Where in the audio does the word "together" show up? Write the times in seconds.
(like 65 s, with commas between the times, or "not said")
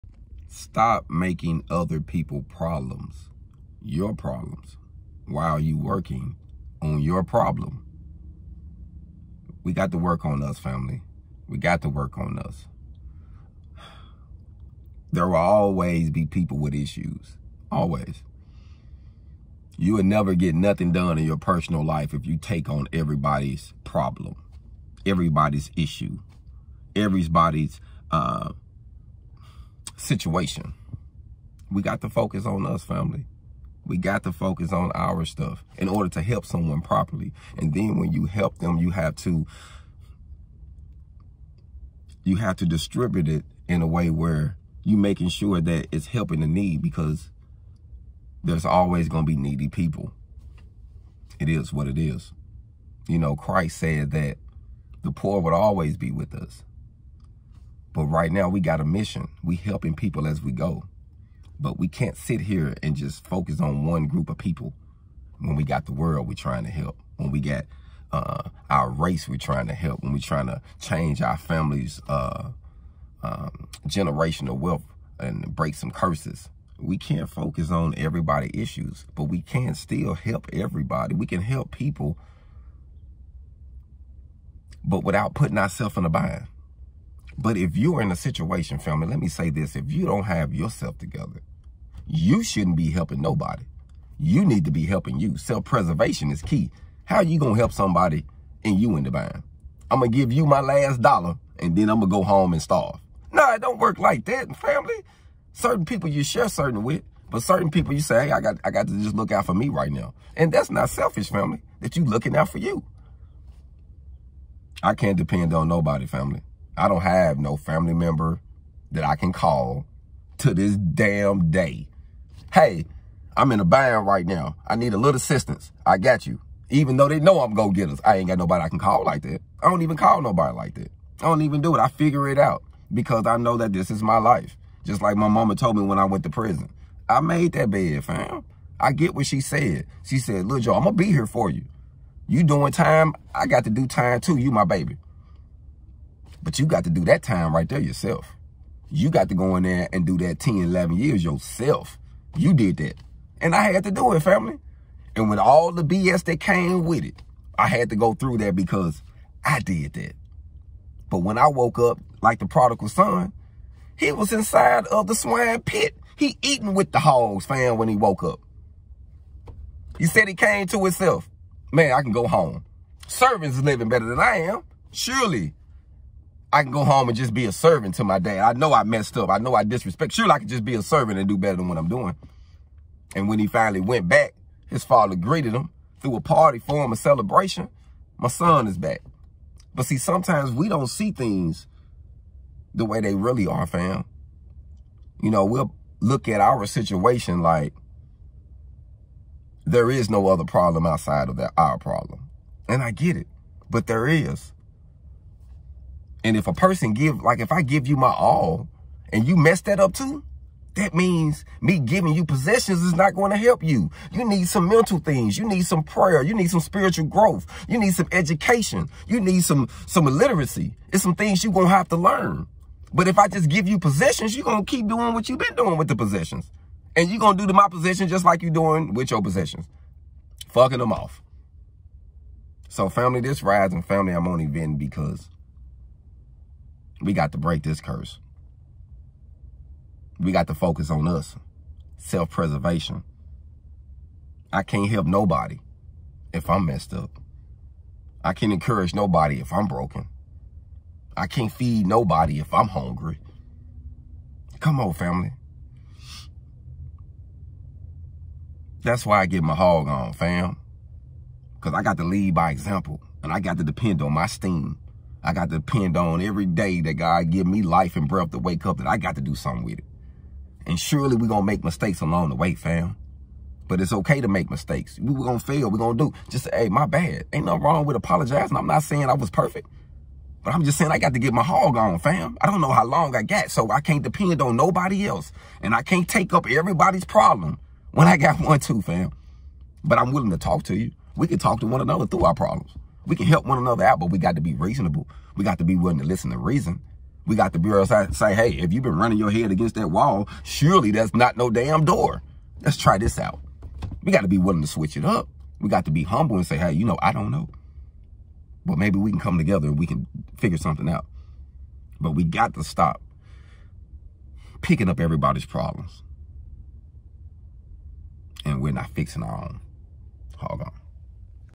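90 s, 309 s.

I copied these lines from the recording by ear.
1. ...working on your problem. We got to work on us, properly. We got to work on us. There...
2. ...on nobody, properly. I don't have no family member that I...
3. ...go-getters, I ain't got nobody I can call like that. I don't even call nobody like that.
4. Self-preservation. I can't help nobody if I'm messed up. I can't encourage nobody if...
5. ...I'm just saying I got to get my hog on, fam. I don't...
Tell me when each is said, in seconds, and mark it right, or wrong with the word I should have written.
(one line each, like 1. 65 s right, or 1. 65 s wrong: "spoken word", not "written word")
1. 5 s wrong: "family", not "properly"
2. 115 s wrong: "family", not "properly"
3. 127 s right
4. 241 s right
5. 280 s right.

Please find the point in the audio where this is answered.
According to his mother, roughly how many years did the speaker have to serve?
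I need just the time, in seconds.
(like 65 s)
150 s.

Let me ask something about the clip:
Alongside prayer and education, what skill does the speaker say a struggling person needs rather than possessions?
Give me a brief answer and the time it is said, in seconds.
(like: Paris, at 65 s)
Literacy, at 220 s.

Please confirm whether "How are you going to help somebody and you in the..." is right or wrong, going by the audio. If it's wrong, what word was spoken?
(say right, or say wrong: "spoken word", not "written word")
right.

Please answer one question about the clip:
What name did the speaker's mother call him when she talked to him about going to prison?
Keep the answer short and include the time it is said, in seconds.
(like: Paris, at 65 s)
Joe, at 140 s.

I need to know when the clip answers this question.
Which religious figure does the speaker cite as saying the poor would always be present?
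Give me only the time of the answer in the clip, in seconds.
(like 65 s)
53 s.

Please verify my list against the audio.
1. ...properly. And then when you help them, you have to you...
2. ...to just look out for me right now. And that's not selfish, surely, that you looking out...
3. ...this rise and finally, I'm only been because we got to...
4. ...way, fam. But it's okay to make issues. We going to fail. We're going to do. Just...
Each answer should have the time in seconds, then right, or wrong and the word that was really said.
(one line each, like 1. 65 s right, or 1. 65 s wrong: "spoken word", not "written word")
1. 36 s right
2. 108 s wrong: "family", not "surely"
3. 233 s wrong: "family", not "finally"
4. 272 s wrong: "mistakes", not "issues".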